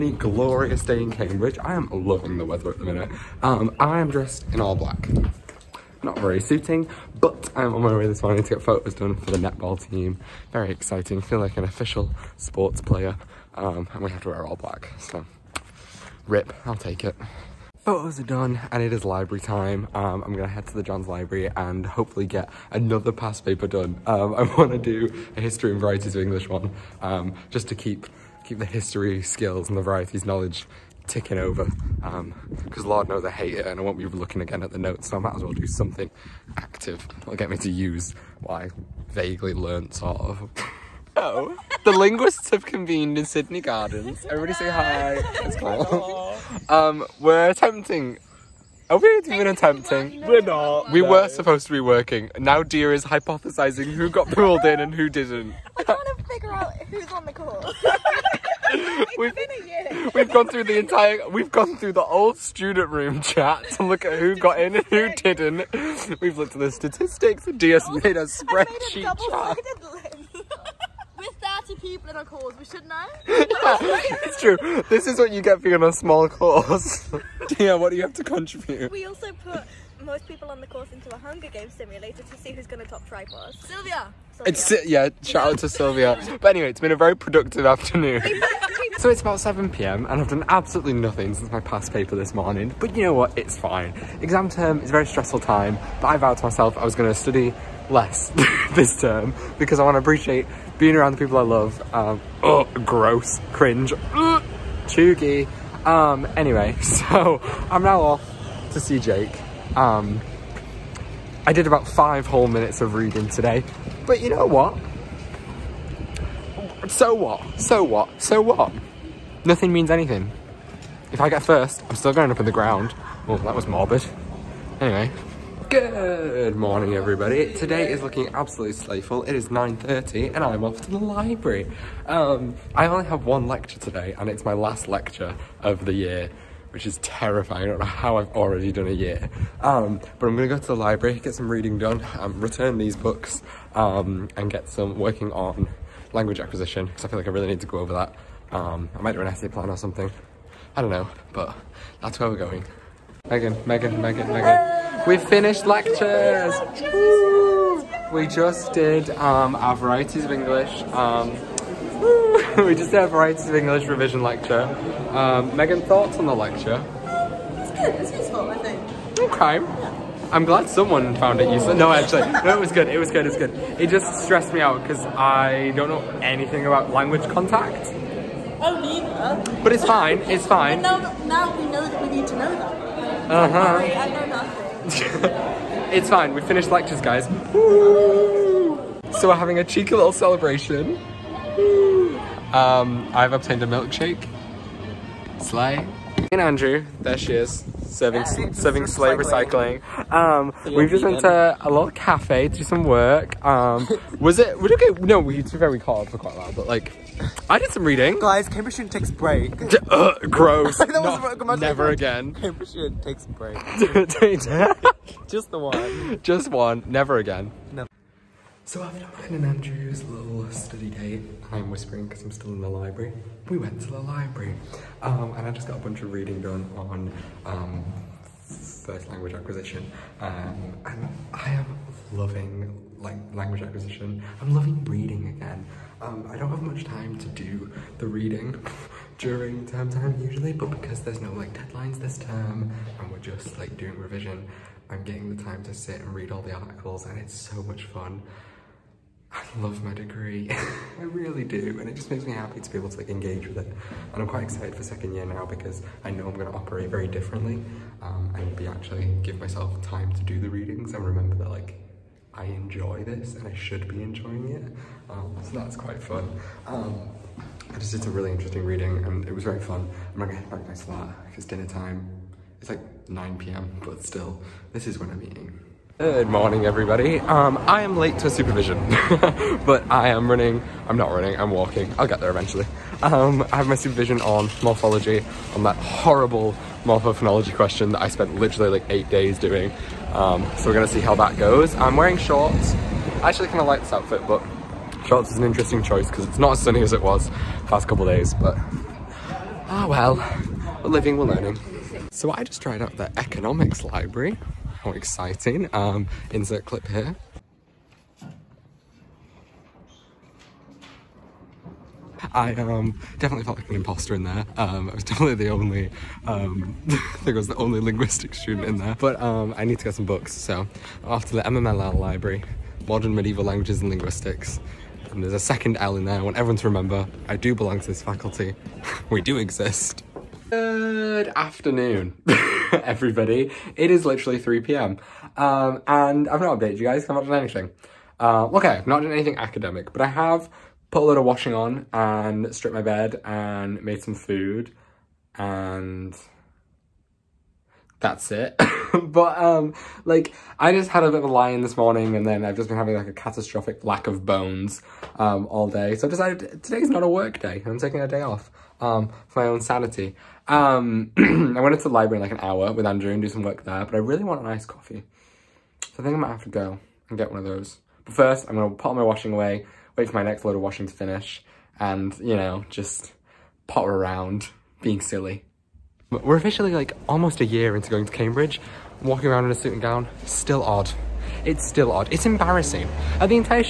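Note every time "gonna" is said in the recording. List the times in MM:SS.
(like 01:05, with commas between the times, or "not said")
00:20, 02:20, 04:50, 06:08.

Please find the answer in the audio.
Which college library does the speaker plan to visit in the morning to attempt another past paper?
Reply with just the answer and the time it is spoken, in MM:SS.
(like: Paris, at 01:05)
John's Library, at 00:20.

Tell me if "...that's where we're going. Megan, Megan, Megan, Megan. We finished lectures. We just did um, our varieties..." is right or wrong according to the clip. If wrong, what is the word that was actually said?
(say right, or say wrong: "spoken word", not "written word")
right.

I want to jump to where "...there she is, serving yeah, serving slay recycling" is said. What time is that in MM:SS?
03:17.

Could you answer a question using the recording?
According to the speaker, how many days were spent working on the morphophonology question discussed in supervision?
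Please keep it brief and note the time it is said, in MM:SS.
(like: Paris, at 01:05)
8, at 04:48.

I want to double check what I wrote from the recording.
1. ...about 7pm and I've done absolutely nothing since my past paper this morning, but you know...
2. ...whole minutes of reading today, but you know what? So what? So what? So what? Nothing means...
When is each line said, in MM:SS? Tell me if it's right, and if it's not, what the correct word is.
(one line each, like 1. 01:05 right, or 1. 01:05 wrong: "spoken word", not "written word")
1. 01:29 right
2. 01:52 right.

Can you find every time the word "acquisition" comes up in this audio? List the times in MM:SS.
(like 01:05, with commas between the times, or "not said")
02:26, 03:49, 03:53.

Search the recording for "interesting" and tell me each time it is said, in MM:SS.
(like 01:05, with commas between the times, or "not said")
04:28, 04:55.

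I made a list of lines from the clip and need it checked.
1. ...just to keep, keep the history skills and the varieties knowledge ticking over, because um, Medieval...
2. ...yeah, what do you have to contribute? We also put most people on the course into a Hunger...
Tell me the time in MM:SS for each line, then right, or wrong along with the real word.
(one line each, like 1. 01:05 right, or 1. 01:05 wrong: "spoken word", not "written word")
1. 00:27 wrong: "Lord", not "Medieval"
2. 01:17 right.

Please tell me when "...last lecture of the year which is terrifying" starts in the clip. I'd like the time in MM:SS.
02:14.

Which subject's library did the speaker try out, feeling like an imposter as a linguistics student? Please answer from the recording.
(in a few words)
economics.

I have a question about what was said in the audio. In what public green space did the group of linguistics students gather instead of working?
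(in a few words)
Sydney Gardens.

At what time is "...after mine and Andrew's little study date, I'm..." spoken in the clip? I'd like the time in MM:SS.
03:38.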